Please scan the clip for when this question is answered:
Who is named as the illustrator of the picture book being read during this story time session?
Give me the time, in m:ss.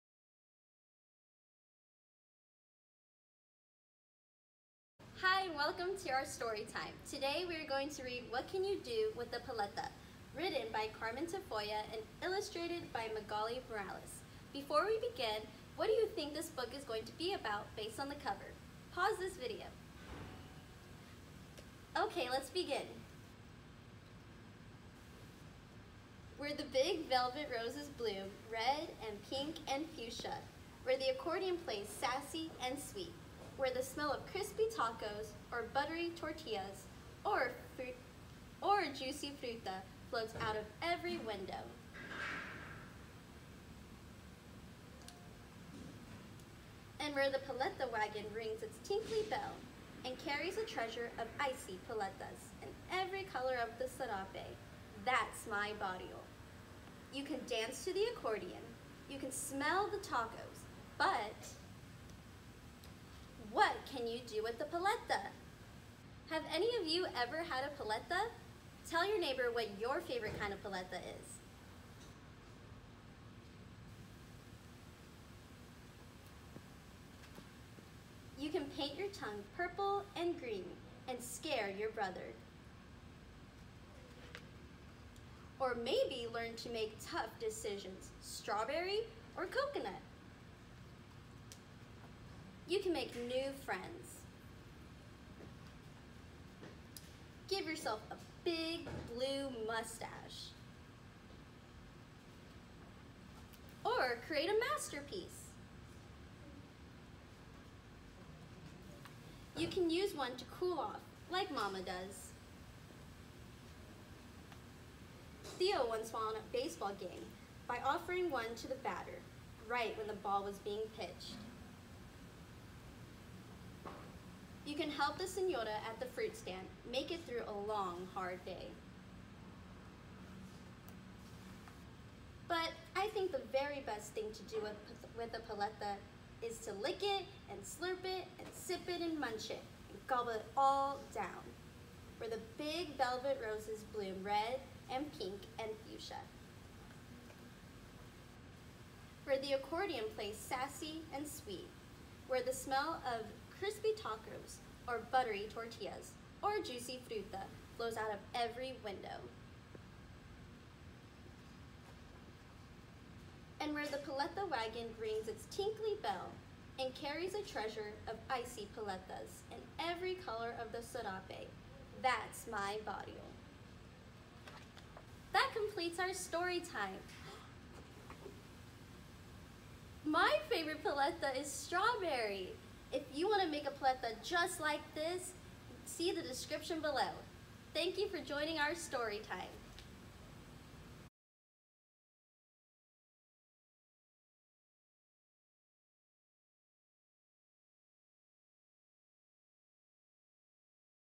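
0:13.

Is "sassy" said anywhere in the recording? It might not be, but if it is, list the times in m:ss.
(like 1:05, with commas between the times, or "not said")
0:31, 2:30.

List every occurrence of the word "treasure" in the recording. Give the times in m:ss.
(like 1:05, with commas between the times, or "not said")
0:50, 2:47.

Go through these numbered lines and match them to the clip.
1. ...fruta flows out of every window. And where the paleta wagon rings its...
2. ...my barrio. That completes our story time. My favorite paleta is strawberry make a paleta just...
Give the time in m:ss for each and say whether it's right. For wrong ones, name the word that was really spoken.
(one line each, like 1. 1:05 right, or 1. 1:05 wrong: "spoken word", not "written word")
1. 2:37 right
2. 2:52 right.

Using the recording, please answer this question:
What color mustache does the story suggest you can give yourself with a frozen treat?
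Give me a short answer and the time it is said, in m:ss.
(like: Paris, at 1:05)
Blue, at 1:38.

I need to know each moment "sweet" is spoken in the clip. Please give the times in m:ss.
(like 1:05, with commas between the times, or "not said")
0:32, 2:31.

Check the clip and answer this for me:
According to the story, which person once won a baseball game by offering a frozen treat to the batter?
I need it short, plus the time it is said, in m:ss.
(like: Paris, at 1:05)
Theo, at 1:55.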